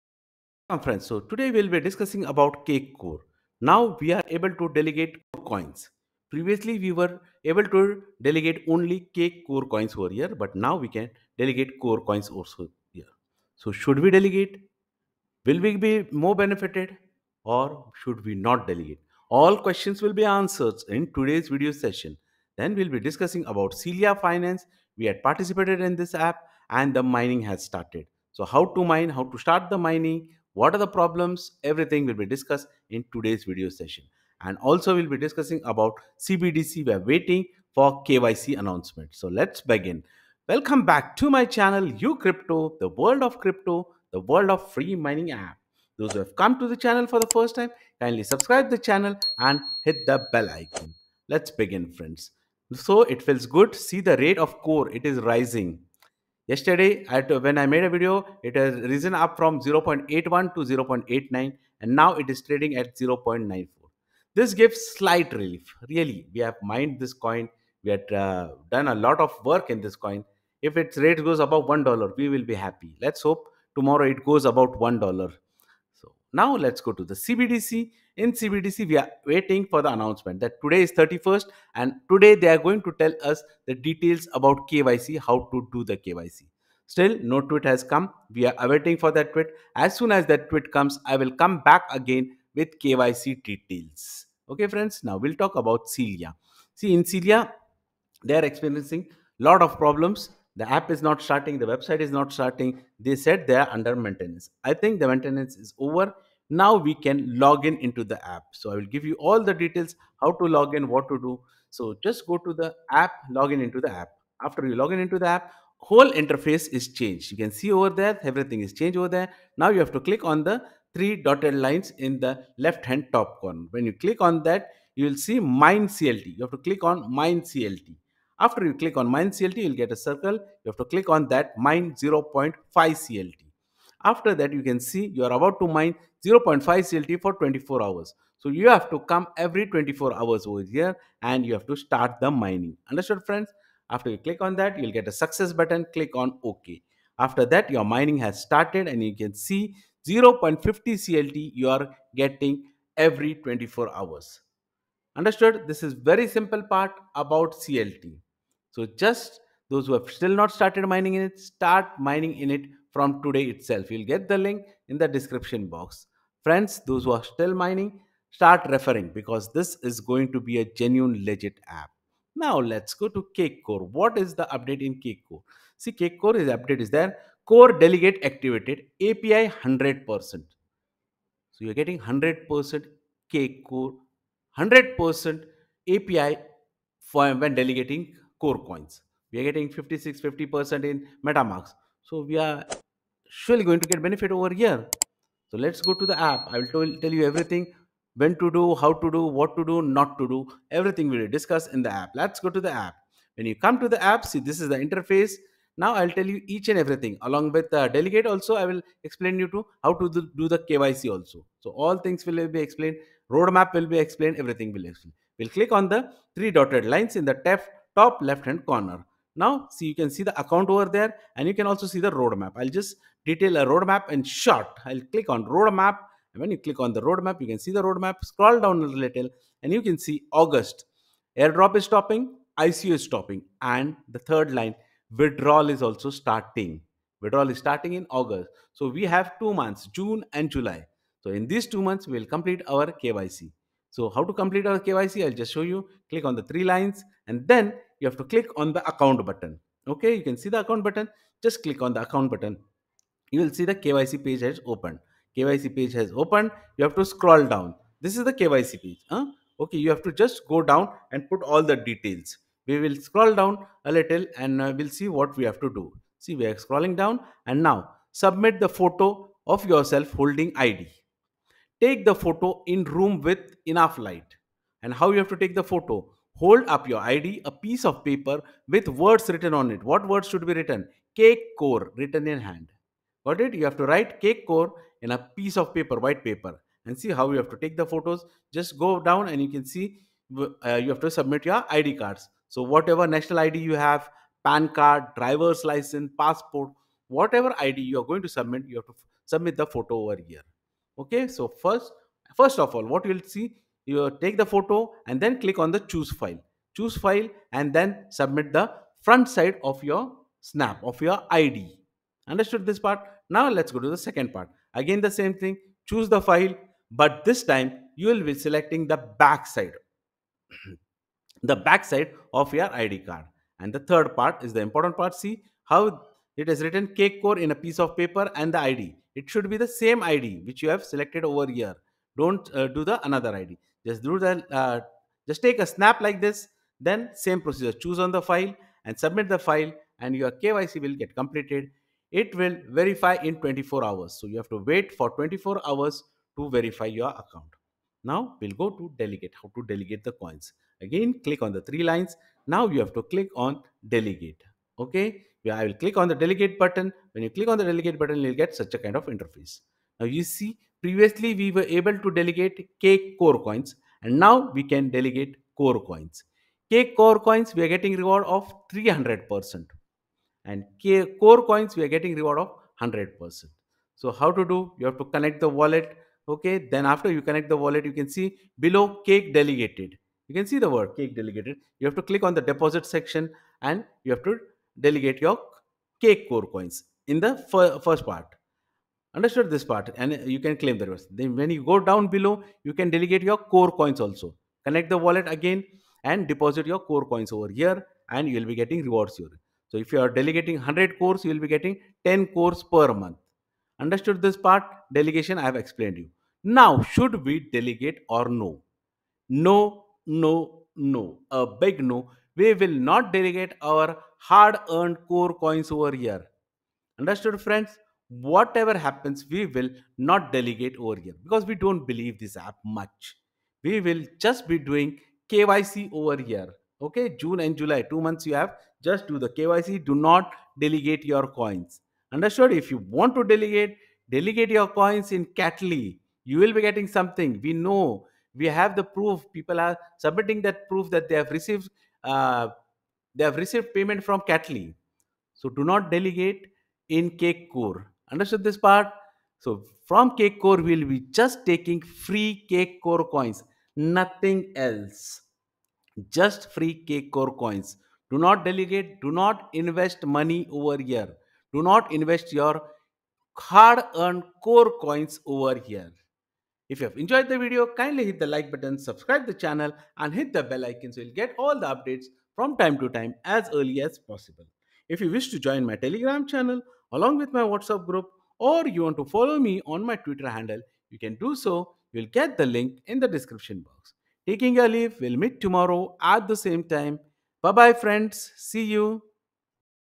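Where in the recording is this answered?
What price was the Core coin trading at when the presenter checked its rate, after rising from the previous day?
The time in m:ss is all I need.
1:02.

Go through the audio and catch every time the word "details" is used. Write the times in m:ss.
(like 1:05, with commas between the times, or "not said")
1:23, 1:33, 1:49, 3:43, 4:21.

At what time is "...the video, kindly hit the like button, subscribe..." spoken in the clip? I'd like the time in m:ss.
7:47.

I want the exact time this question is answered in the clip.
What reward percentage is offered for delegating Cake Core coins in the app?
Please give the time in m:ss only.
6:08.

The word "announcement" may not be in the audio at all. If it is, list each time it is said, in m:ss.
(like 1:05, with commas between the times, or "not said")
0:38, 1:19.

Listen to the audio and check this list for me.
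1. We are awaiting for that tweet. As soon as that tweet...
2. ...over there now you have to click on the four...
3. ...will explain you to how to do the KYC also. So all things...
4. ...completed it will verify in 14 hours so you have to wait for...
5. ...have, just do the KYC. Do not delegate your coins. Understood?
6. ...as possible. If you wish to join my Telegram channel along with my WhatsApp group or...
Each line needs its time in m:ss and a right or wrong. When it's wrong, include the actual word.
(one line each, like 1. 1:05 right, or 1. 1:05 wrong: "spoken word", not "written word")
1. 1:28 right
2. 1:58 wrong: "three", not "four"
3. 3:28 right
4. 5:41 wrong: "24", not "14"
5. 7:08 right
6. 7:53 right.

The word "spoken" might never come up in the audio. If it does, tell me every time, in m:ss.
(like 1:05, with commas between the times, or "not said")
not said.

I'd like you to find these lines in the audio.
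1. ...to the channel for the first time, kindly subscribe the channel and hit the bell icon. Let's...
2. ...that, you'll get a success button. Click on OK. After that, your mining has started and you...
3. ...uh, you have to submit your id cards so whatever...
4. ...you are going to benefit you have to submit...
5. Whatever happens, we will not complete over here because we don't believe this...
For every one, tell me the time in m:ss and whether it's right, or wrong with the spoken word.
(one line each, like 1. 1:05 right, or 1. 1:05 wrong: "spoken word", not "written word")
1. 0:46 right
2. 2:24 right
3. 4:50 right
4. 4:57 wrong: "submit", not "benefit"
5. 6:58 wrong: "delegate", not "complete".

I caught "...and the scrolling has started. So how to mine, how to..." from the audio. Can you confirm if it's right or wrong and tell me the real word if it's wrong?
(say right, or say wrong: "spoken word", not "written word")
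wrong: "mining", not "scrolling".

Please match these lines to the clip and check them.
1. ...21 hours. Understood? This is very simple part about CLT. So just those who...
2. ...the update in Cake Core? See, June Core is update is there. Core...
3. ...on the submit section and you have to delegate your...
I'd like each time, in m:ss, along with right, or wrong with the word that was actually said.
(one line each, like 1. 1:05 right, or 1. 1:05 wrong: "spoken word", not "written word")
1. 2:33 wrong: "24", not "21"
2. 2:54 wrong: "Cake", not "June"
3. 6:22 wrong: "deposit", not "submit".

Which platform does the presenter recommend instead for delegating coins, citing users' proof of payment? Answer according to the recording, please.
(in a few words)
Catly.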